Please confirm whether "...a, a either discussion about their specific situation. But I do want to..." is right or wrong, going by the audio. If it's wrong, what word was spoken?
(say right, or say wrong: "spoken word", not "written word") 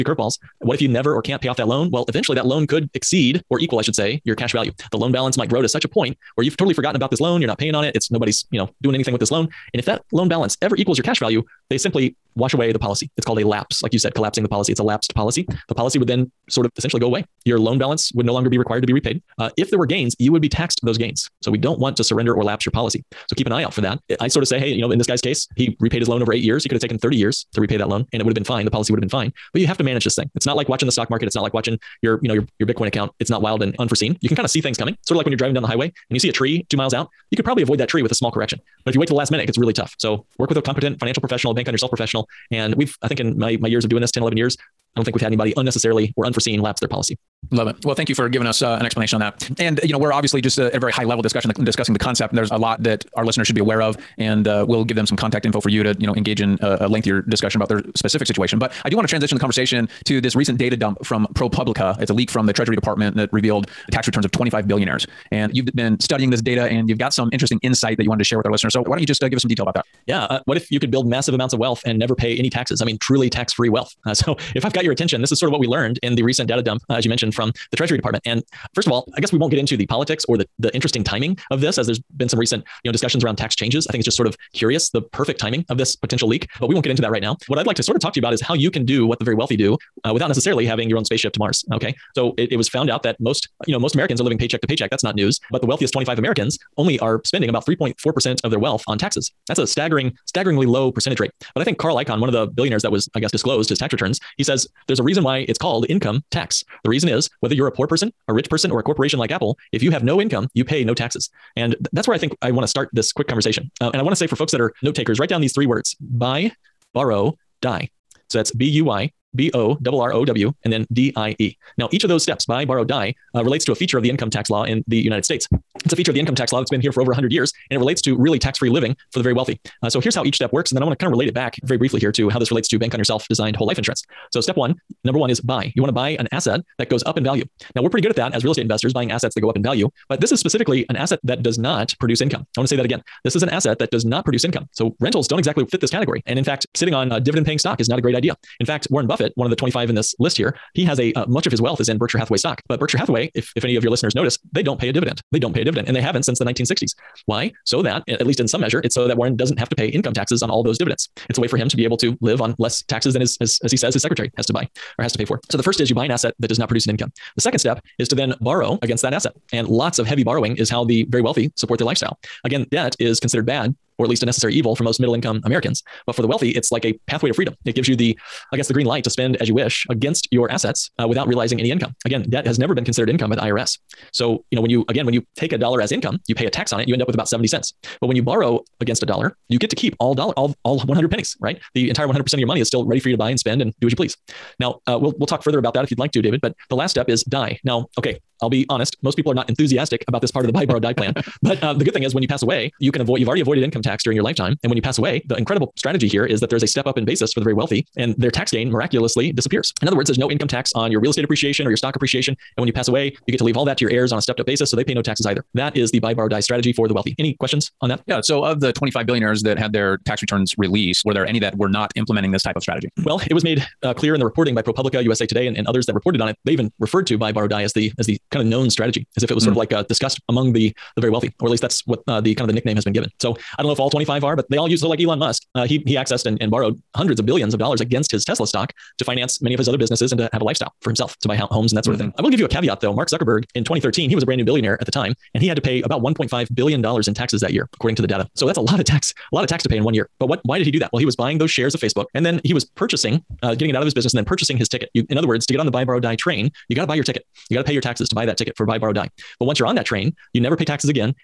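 wrong: "lengthier", not "either".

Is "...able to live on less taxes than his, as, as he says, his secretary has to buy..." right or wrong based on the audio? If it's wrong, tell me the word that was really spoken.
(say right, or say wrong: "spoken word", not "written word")
right.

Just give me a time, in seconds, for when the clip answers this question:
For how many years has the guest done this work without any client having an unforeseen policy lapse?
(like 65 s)
44 s.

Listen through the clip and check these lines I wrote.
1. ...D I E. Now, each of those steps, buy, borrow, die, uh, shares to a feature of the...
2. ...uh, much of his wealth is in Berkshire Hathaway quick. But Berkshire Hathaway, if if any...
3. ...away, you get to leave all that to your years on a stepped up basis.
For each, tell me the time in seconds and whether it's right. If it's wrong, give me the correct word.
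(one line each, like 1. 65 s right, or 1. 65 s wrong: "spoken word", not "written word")
1. 120 s wrong: "relates", not "shares"
2. 151 s wrong: "stock", not "quick"
3. 212 s wrong: "heirs", not "years".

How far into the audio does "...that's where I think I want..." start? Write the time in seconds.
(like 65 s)
111 s.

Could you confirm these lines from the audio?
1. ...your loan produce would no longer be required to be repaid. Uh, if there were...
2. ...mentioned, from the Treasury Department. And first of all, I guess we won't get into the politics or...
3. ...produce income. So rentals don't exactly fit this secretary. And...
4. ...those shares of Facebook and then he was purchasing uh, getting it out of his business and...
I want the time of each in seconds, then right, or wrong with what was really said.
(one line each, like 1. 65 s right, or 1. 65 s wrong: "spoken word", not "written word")
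1. 17 s wrong: "balance", not "produce"
2. 77 s right
3. 144 s wrong: "category", not "secretary"
4. 251 s right.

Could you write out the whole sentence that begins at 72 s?
I mean, truly tax free wealth.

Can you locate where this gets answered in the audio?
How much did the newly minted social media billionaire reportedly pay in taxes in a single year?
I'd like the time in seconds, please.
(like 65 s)
246 s.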